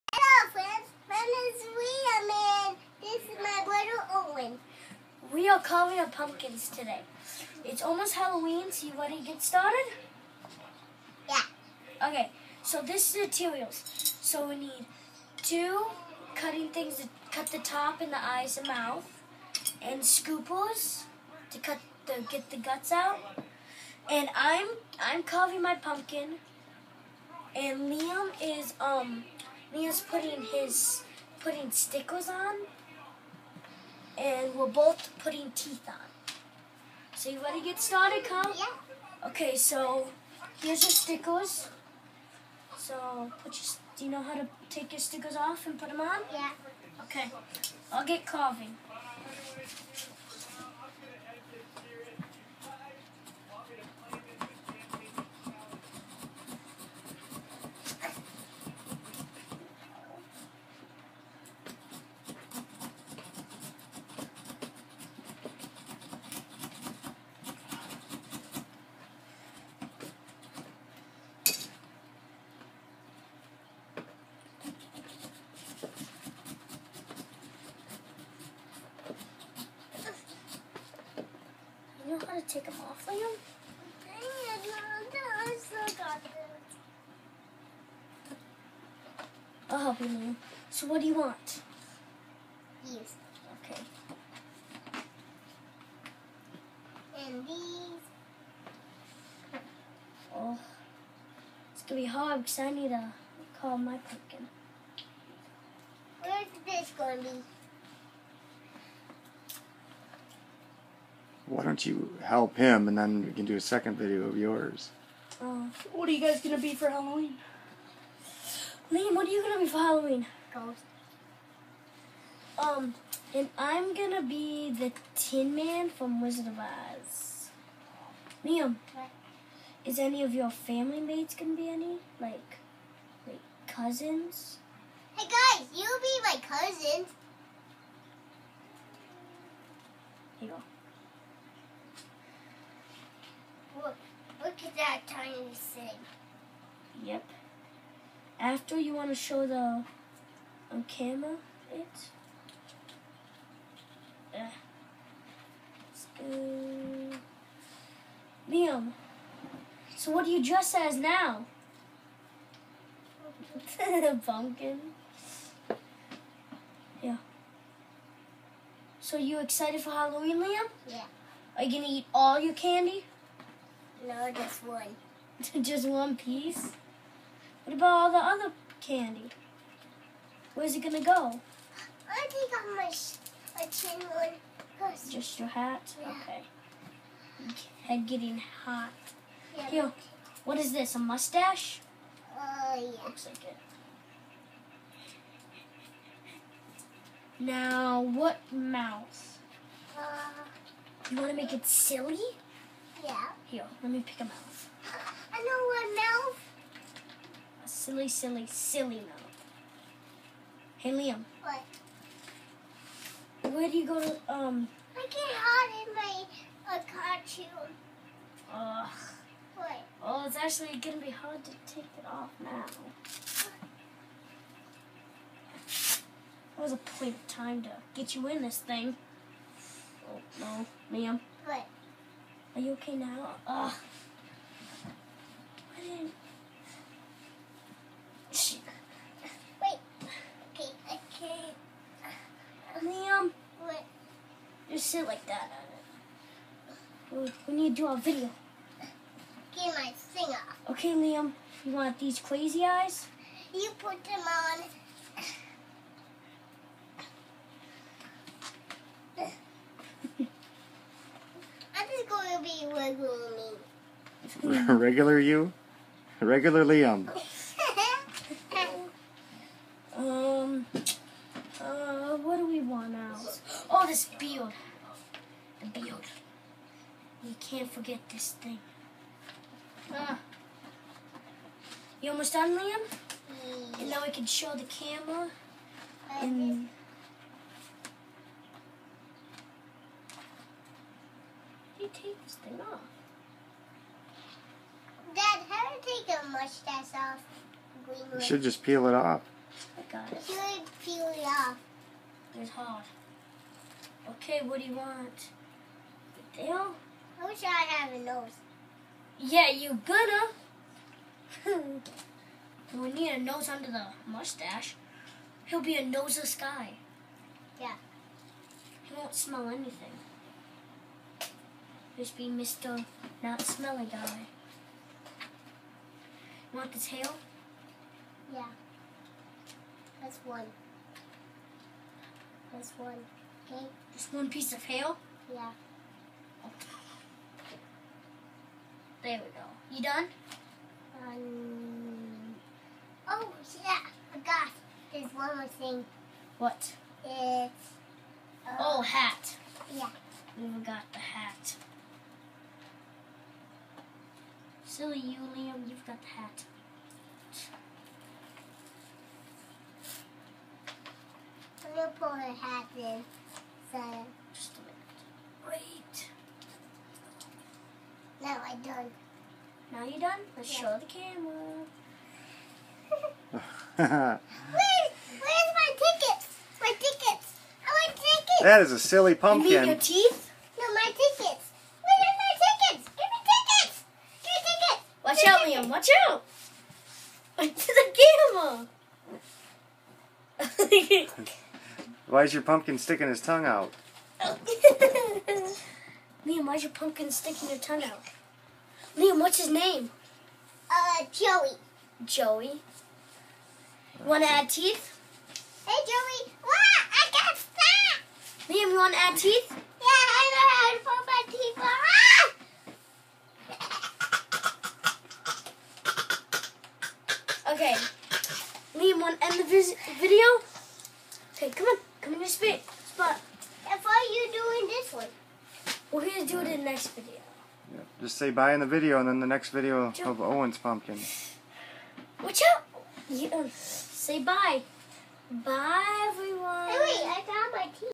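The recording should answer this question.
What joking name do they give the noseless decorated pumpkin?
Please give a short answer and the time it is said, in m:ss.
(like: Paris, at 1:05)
Mr. Not Smelly Guy, at 5:22.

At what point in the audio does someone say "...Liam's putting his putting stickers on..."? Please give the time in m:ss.
0:29.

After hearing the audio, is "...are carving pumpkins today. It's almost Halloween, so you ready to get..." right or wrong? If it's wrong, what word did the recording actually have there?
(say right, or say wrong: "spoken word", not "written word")
right.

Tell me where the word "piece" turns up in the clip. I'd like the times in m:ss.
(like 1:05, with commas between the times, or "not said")
2:56, 5:34.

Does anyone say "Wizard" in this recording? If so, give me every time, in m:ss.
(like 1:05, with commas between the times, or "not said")
2:06.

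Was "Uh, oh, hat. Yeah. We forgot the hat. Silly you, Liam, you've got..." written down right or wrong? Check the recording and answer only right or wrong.
right.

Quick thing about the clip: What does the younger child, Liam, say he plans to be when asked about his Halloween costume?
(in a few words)
Ghost.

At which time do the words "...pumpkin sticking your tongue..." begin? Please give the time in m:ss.
6:36.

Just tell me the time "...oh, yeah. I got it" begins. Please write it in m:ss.
5:43.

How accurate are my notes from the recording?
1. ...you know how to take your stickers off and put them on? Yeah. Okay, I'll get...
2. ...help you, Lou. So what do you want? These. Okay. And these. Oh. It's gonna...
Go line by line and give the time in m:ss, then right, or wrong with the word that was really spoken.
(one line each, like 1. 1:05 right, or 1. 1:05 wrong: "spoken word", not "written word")
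1. 0:44 right
2. 1:29 right.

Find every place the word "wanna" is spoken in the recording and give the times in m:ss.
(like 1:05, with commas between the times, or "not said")
6:44, 6:48.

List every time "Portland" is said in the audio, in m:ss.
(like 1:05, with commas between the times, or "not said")
not said.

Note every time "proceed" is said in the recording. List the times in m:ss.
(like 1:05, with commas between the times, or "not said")
not said.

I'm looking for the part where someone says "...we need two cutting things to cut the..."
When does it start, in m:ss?
0:14.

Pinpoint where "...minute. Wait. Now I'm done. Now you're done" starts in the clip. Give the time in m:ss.
6:05.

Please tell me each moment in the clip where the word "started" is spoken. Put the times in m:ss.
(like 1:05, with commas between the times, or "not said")
0:09, 0:37.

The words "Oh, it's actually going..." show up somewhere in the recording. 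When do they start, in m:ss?
3:40.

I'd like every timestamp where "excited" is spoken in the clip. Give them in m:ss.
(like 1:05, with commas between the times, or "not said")
2:49.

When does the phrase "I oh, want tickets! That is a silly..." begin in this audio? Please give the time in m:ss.
6:17.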